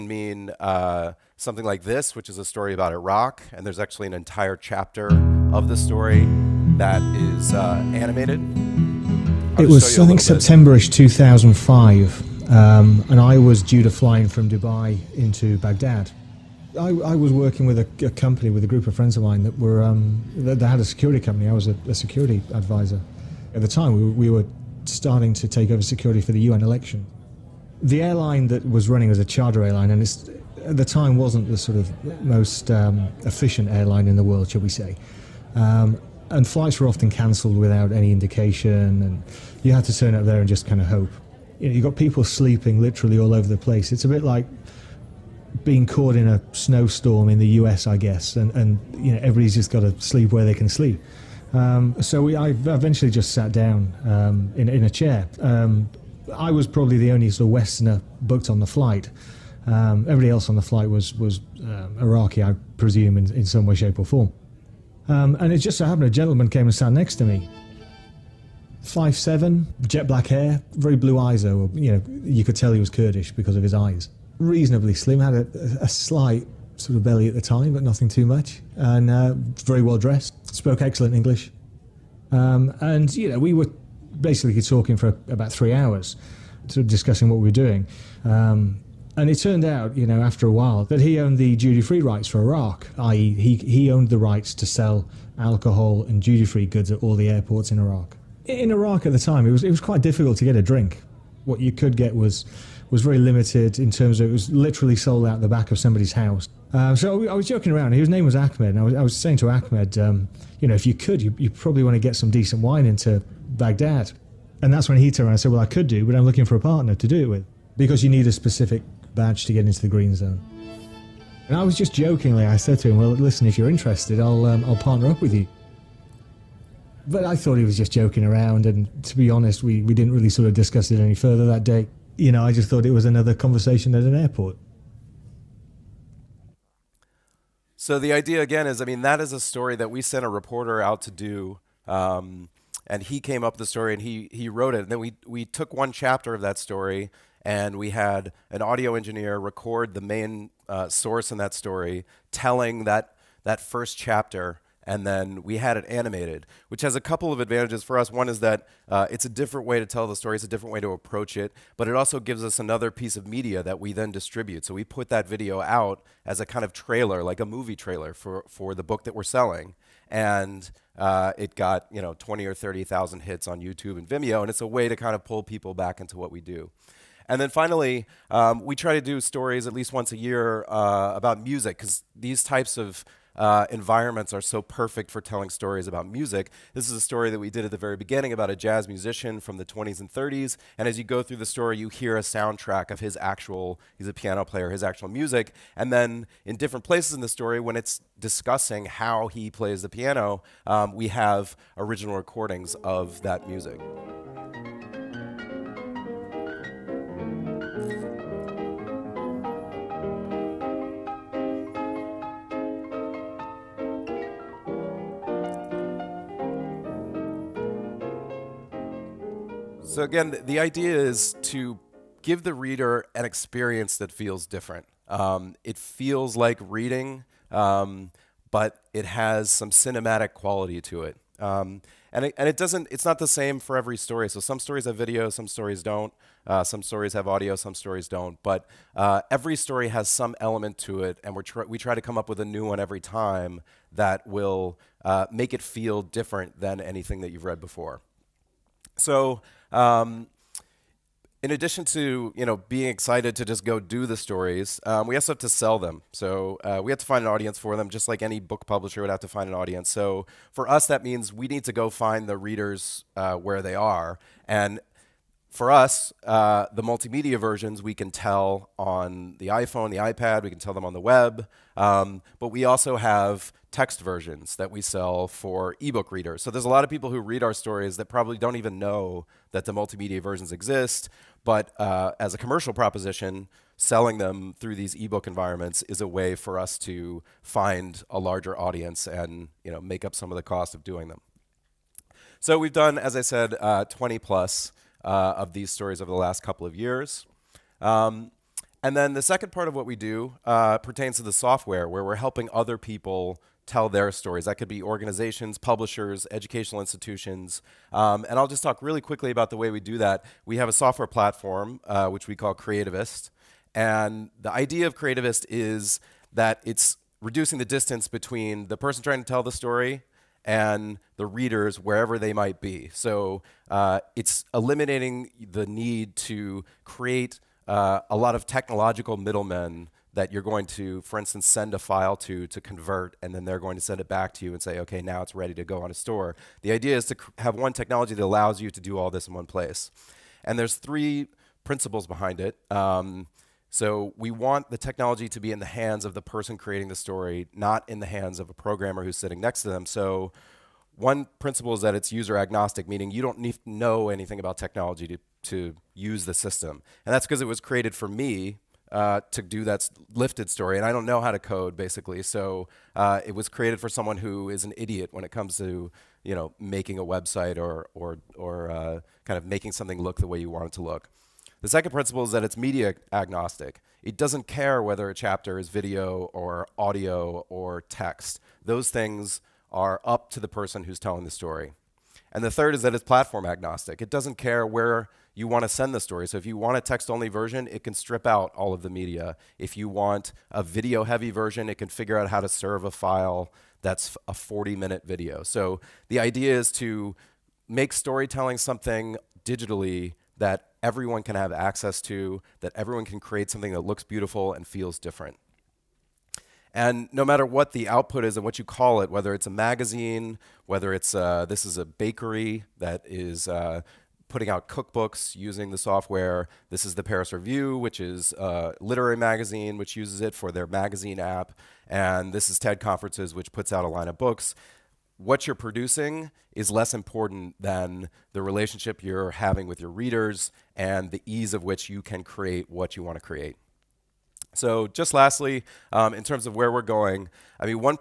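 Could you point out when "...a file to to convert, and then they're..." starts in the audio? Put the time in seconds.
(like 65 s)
331 s.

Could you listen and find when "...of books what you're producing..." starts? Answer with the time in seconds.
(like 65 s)
424 s.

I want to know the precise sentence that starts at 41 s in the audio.
You know, you've got people sleeping literally all over the place.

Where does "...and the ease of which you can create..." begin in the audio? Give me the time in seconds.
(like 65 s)
430 s.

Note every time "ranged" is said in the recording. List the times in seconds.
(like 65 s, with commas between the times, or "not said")
not said.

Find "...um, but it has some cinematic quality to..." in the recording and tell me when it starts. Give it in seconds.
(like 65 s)
227 s.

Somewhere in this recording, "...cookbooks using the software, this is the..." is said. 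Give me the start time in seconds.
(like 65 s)
414 s.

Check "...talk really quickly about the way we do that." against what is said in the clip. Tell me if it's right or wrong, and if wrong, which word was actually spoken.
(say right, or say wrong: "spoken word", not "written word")
right.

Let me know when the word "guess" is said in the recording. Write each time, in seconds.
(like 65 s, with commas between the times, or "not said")
47 s.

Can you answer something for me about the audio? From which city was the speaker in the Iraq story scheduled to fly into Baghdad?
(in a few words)
Dubai.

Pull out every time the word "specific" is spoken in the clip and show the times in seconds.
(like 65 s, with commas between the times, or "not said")
118 s.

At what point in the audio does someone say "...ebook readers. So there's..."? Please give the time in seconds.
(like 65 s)
275 s.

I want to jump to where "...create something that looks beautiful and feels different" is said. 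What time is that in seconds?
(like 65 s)
403 s.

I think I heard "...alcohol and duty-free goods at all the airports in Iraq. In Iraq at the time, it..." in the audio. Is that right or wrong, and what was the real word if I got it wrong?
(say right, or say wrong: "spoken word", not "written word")
right.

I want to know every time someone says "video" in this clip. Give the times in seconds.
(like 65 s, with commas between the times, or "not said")
165 s, 234 s, 375 s, 390 s, 395 s.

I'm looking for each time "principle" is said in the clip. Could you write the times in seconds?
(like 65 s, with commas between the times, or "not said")
341 s, 351 s, 371 s.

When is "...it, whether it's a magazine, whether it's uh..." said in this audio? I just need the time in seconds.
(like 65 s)
409 s.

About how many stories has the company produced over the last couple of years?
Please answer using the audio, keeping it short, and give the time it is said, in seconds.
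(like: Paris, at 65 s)
20 plus, at 293 s.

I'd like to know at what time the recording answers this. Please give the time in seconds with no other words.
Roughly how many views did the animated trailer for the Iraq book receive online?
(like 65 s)
172 s.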